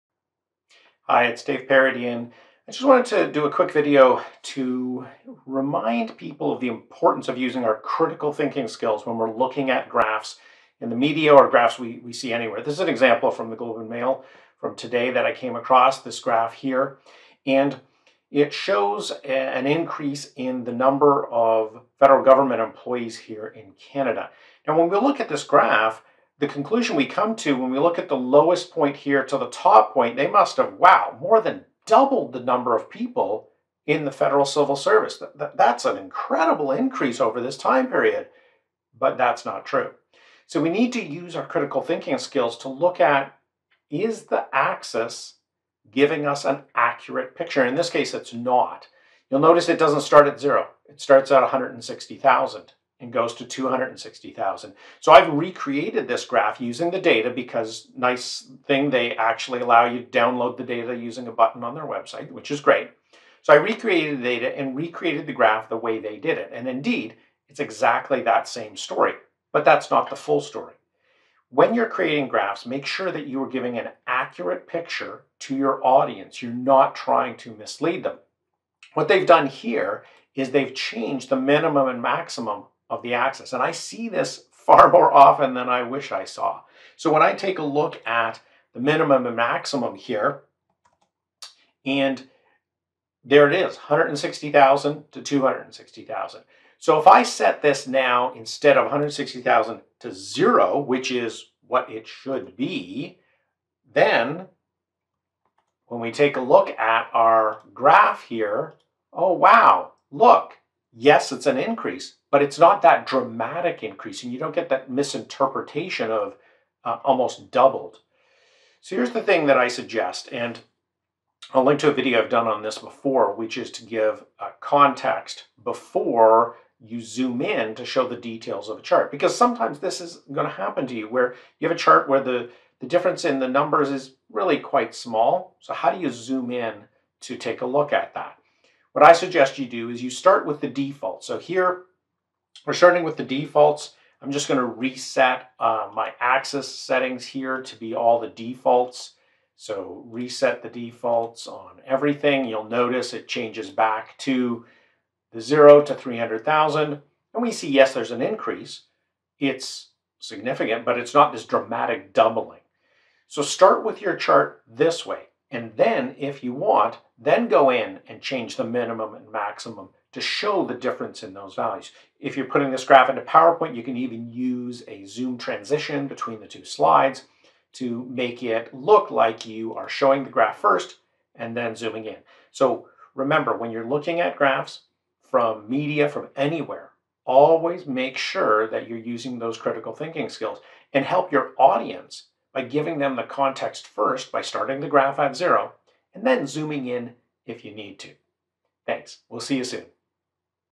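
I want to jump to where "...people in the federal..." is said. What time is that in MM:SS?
00:32.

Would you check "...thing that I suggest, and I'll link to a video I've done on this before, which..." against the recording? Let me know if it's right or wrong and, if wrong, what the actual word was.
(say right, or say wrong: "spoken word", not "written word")
right.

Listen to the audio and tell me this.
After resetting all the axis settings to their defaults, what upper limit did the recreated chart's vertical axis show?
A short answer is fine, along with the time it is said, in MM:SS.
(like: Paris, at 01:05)
300,000, at 02:35.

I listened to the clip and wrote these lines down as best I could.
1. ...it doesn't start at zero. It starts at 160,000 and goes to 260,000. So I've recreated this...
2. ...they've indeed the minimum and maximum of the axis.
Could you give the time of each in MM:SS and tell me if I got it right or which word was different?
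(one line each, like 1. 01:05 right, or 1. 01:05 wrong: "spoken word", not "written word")
1. 00:49 right
2. 01:20 wrong: "changed", not "indeed".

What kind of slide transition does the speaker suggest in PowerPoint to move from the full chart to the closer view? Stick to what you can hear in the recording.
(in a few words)
Zoom transition.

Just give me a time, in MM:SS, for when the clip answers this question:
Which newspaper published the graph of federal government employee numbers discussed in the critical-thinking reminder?
00:13.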